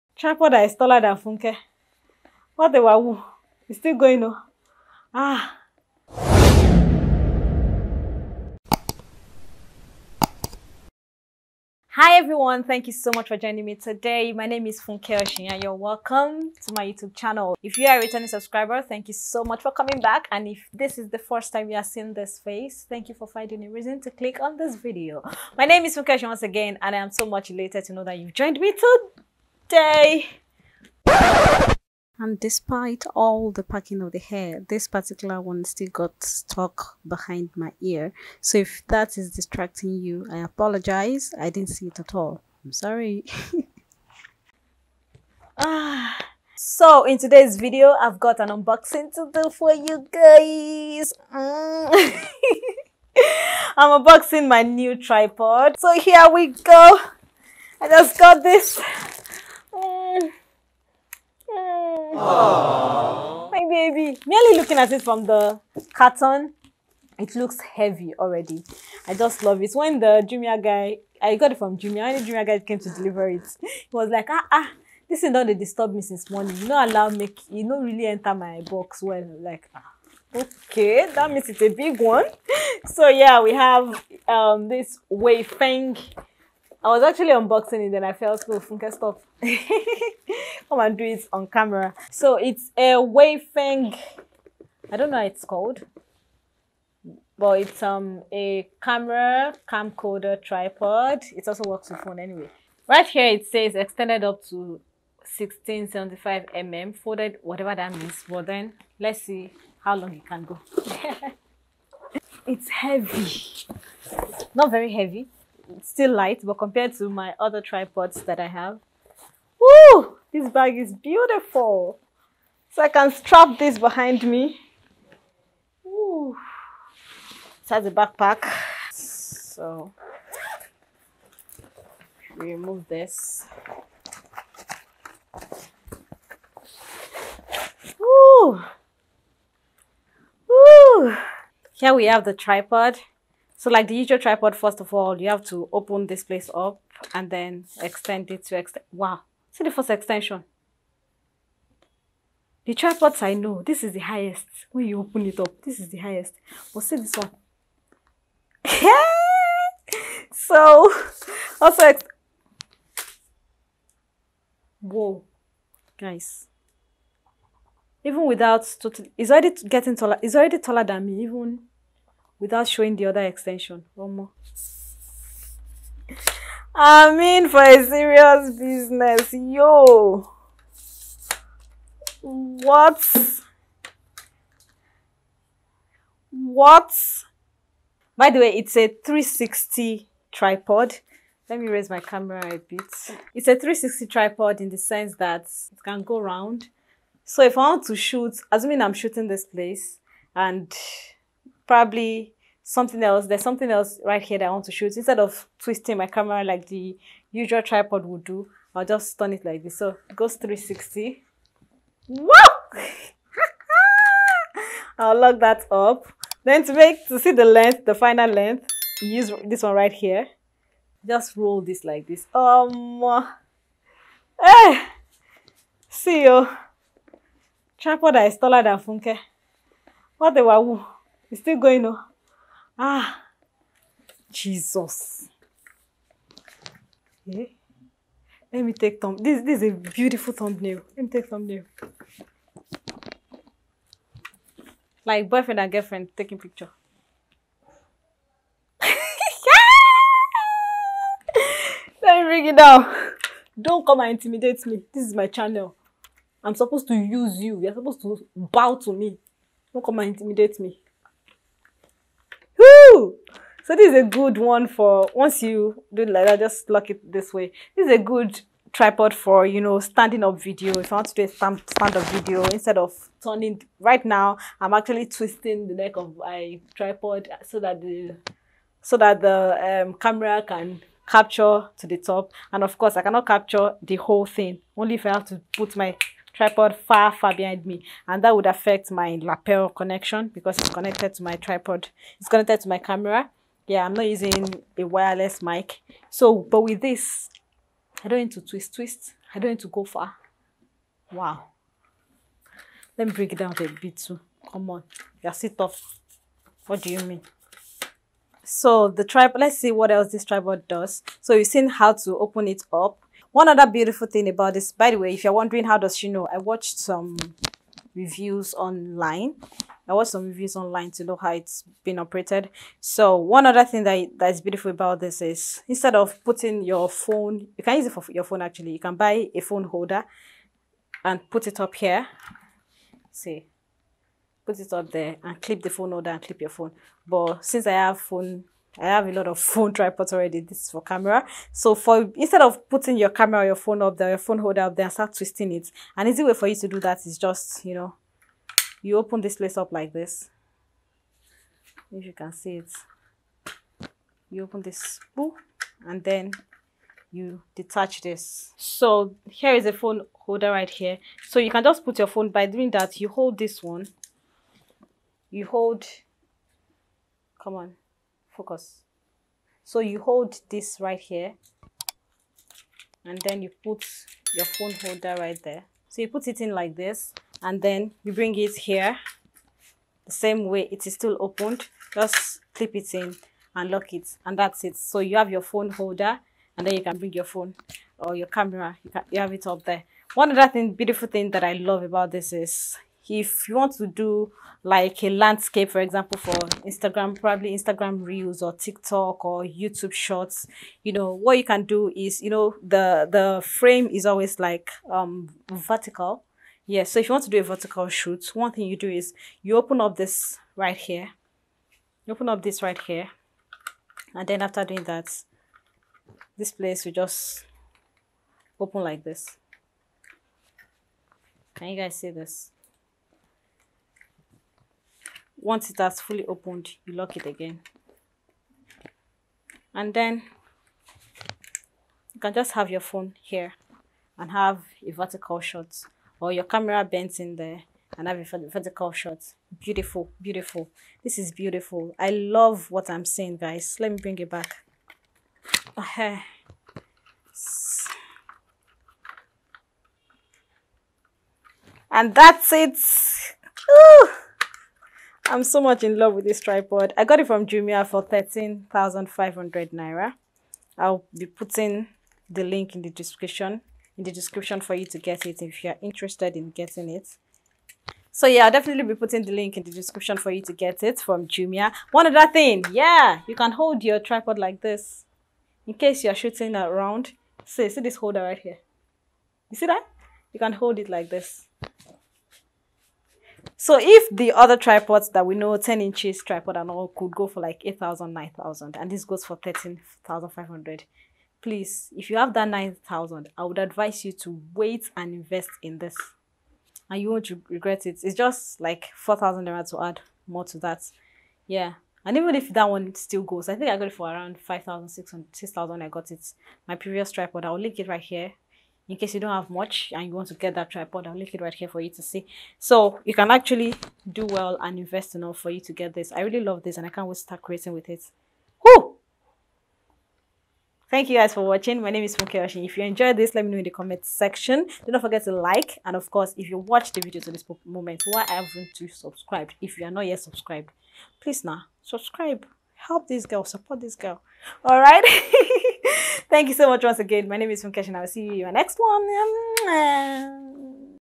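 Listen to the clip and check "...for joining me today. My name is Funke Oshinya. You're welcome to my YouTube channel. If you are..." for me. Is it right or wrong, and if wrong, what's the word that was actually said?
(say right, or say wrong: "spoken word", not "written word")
right.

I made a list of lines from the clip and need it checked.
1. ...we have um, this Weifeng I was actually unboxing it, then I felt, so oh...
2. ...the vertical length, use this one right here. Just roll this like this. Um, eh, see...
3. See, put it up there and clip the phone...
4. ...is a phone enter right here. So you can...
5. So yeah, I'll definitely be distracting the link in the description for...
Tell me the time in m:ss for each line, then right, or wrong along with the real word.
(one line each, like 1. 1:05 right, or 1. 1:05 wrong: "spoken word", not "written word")
1. 1:23 right
2. 3:37 wrong: "final", not "vertical"
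3. 5:33 right
4. 5:59 wrong: "holder", not "enter"
5. 7:48 wrong: "putting", not "distracting".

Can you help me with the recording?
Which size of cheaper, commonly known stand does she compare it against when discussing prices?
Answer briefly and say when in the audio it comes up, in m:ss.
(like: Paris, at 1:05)
10 inches, at 8:05.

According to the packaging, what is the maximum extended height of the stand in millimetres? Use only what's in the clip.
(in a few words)
1675 mm.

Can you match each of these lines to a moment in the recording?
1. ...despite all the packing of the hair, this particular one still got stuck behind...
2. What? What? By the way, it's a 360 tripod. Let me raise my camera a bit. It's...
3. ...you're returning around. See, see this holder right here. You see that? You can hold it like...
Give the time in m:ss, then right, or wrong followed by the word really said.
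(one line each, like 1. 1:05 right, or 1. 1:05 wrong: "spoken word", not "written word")
1. 0:32 right
2. 3:02 right
3. 7:56 wrong: "shooting", not "returning".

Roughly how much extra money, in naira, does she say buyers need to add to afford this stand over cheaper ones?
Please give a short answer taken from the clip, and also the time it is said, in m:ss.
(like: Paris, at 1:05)
4,000 naira, at 8:18.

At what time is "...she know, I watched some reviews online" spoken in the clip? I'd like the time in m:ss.
5:15.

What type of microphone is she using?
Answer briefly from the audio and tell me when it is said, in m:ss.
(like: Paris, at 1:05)
lapel, at 4:49.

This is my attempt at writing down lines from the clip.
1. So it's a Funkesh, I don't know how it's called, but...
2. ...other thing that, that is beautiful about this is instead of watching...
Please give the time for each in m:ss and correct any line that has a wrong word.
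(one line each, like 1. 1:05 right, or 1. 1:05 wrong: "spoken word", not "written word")
1. 1:32 wrong: "Weifeng", not "Funkesh"
2. 5:23 wrong: "putting", not "watching".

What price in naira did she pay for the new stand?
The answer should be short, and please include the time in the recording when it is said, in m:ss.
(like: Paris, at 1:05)
13,500 Naira, at 7:38.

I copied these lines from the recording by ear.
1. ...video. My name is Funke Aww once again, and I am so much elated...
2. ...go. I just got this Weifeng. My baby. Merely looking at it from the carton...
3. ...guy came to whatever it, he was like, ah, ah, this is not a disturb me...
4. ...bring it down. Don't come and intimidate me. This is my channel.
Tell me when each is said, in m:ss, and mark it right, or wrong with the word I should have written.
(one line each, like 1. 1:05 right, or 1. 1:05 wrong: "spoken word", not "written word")
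1. 0:24 wrong: "Oshinya", not "Aww"
2. 0:56 wrong: "Aww", not "Weifeng"
3. 1:12 wrong: "deliver", not "whatever"
4. 4:12 right.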